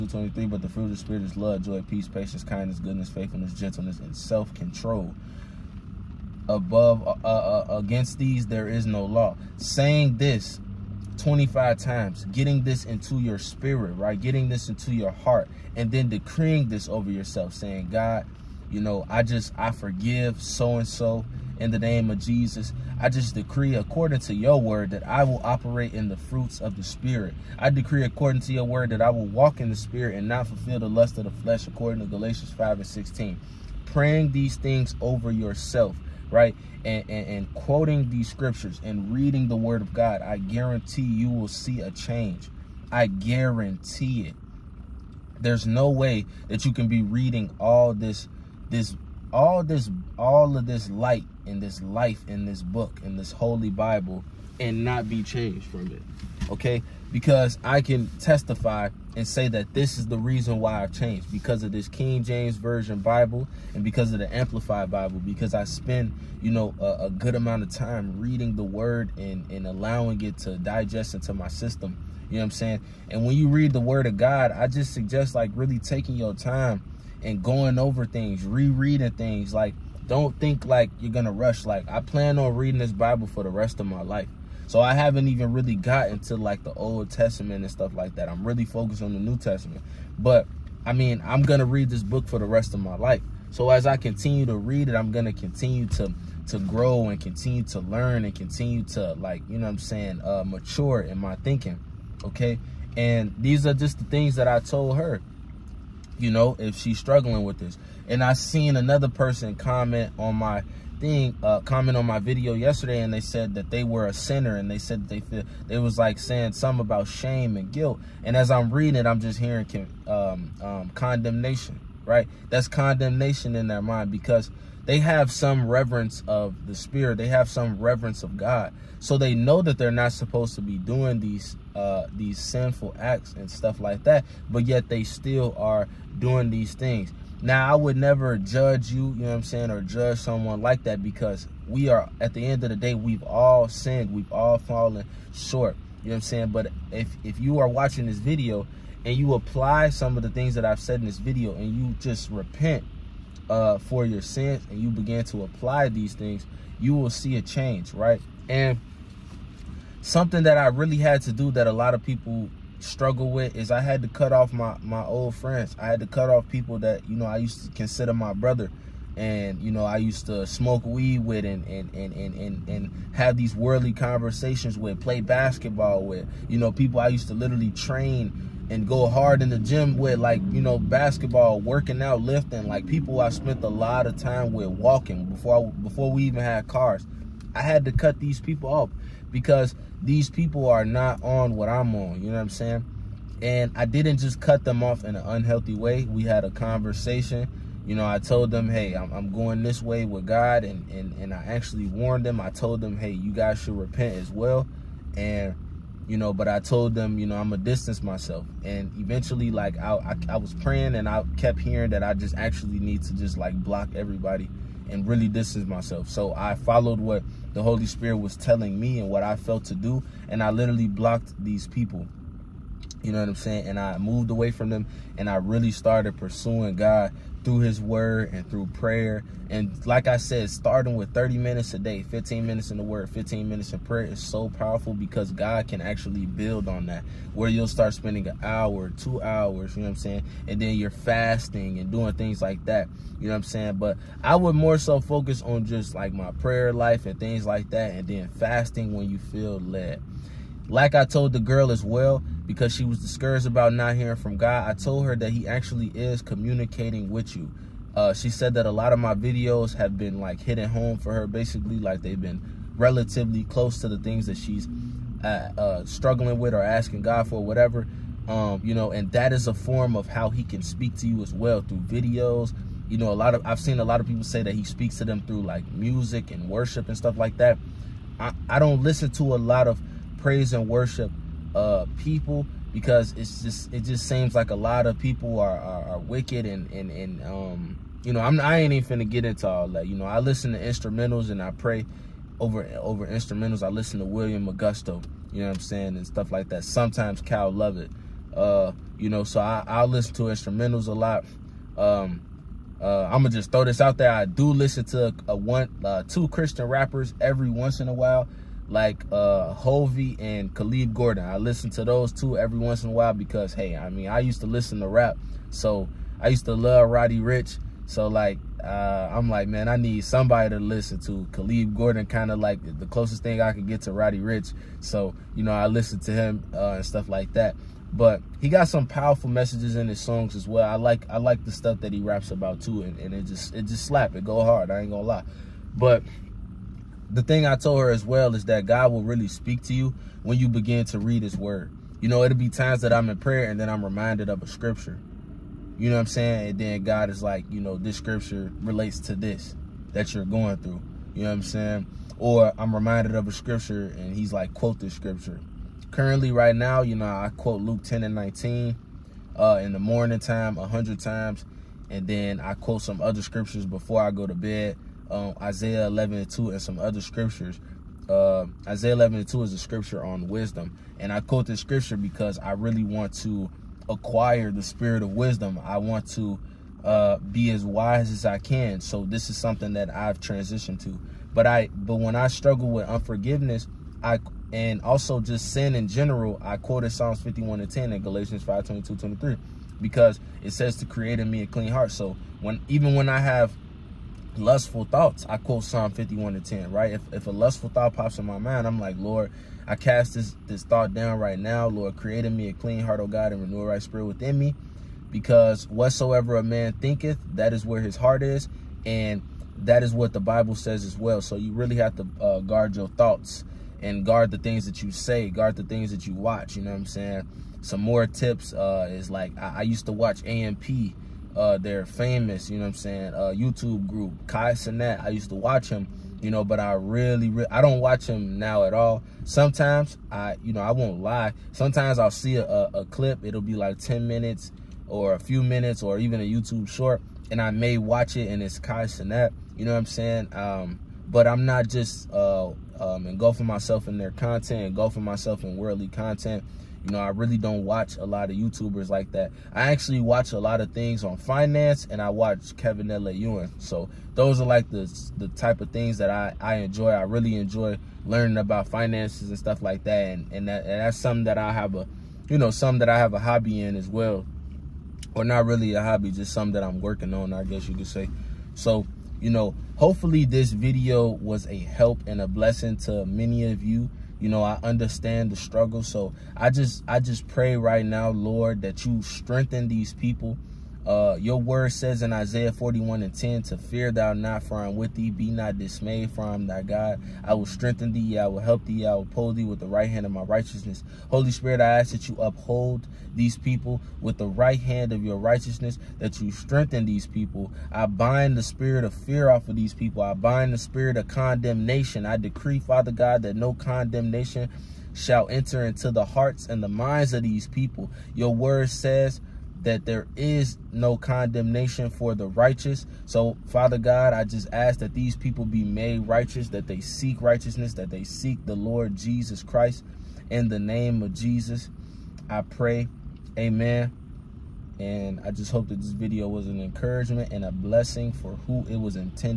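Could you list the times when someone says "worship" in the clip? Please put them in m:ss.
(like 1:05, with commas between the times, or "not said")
4:36, 4:40.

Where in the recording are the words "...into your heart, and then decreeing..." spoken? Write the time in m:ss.
0:14.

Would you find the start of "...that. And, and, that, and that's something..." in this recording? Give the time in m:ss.
7:39.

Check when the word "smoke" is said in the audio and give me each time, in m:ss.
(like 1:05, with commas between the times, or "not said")
2:50.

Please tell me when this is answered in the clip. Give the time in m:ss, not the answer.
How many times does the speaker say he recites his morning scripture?
6:00.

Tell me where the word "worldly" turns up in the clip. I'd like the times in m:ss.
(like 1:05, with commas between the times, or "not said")
2:53, 7:25.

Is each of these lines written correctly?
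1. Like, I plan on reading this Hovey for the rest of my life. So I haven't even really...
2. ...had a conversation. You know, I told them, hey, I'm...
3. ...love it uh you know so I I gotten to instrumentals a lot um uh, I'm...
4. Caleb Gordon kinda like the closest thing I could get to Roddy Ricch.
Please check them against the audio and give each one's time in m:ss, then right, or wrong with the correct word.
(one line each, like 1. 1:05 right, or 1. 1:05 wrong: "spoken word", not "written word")
1. 1:21 wrong: "Bible", not "Hovey"
2. 3:16 right
3. 4:57 wrong: "listen", not "gotten"
4. 5:21 right.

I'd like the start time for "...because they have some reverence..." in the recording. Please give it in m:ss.
2:04.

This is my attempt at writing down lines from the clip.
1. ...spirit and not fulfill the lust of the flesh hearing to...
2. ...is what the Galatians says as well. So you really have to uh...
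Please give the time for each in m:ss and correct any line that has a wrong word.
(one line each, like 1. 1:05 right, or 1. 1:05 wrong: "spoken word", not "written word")
1. 0:29 wrong: "according", not "hearing"
2. 6:49 wrong: "Bible", not "Galatians".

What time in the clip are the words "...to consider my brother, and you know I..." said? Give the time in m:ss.
2:47.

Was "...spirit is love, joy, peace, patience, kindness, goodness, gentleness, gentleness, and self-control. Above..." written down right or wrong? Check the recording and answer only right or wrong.
wrong.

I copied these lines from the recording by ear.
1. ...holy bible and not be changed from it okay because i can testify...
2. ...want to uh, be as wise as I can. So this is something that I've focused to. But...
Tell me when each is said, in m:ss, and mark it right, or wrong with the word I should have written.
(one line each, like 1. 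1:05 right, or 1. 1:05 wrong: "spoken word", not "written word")
1. 0:53 right
2. 6:15 wrong: "transitioned", not "focused".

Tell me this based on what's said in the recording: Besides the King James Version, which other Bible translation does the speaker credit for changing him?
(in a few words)
Amplified Bible.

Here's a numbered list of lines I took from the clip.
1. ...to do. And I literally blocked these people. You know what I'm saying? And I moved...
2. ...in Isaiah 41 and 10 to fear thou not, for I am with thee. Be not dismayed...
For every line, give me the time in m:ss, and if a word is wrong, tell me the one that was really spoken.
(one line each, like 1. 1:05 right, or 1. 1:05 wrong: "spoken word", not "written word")
1. 3:39 right
2. 8:02 right.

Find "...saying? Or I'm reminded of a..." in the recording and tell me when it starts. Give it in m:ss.
5:51.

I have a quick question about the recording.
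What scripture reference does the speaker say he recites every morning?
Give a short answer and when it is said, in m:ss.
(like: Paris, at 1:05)
Luke 10:19, at 5:57.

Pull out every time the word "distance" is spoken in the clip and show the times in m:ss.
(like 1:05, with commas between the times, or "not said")
3:27, 3:35.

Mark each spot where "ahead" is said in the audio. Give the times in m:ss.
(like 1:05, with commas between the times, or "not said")
not said.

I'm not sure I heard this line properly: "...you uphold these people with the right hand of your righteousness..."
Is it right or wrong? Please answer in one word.
right.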